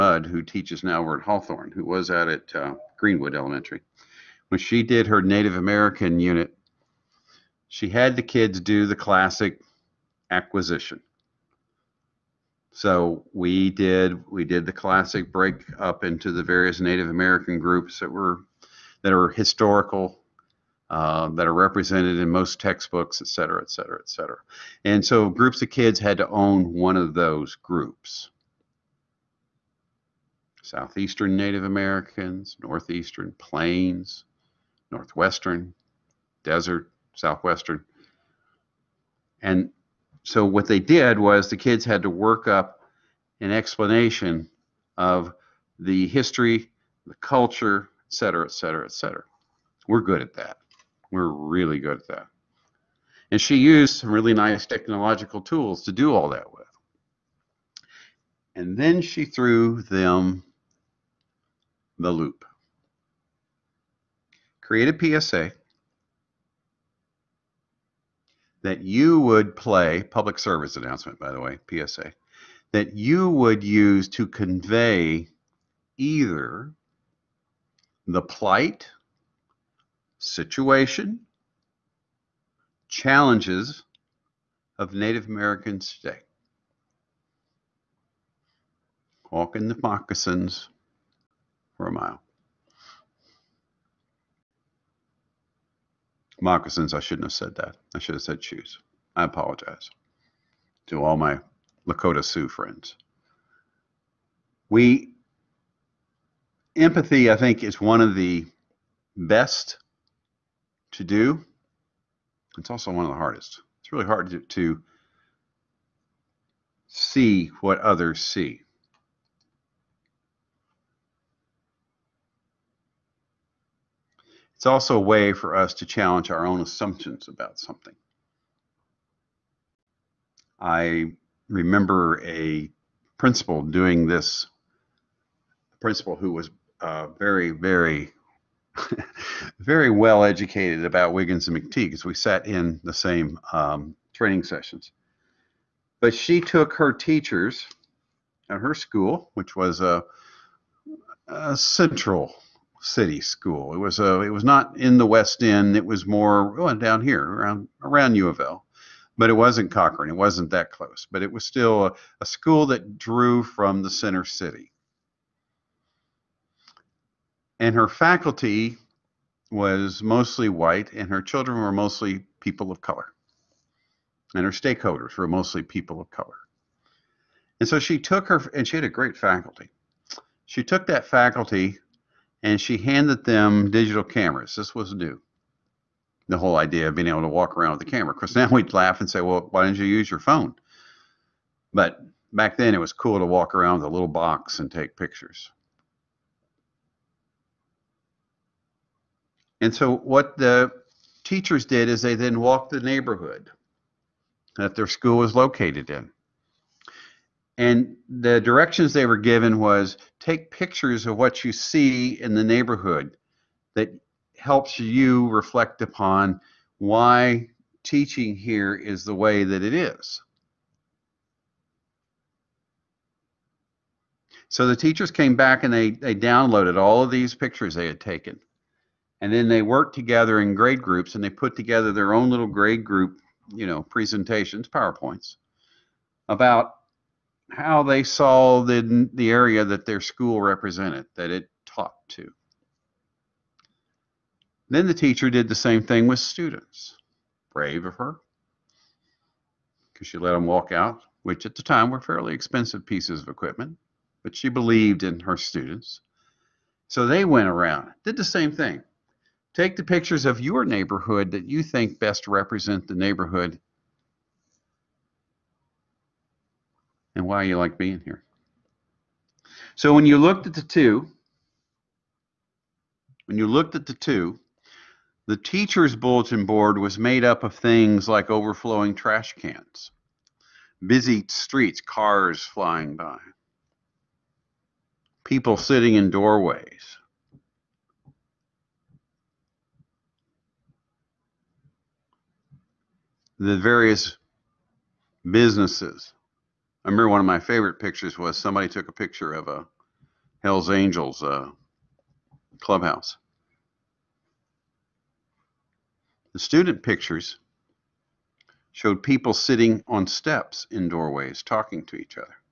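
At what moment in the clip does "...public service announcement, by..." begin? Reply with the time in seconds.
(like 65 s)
70 s.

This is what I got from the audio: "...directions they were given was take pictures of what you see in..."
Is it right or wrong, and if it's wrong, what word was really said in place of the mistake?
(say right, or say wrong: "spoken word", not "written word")
right.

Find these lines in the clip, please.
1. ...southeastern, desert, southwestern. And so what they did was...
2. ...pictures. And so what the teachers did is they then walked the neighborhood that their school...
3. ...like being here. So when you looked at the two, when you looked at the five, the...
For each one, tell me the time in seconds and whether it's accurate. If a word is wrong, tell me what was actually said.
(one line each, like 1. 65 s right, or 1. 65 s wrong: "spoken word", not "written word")
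1. 34 s wrong: "northwestern", not "southeastern"
2. 194 s right
3. 267 s wrong: "two", not "five".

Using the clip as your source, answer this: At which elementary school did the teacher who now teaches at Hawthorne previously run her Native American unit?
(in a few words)
Greenwood Elementary.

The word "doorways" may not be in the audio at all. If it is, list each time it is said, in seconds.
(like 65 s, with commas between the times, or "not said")
286 s, 310 s.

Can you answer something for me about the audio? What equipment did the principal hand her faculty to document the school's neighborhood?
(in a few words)
Digital cameras.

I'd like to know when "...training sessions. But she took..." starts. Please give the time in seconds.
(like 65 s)
144 s.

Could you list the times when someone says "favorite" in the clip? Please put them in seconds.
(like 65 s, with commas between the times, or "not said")
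297 s.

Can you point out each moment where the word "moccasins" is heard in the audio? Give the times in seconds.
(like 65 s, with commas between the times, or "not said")
89 s, 96 s.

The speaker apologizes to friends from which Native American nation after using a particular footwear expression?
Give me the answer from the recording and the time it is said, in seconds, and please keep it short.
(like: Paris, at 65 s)
Lakota Sioux, at 101 s.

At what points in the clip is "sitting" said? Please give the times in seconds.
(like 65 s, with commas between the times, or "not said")
285 s, 309 s.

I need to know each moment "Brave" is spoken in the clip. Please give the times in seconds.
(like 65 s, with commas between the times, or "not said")
247 s.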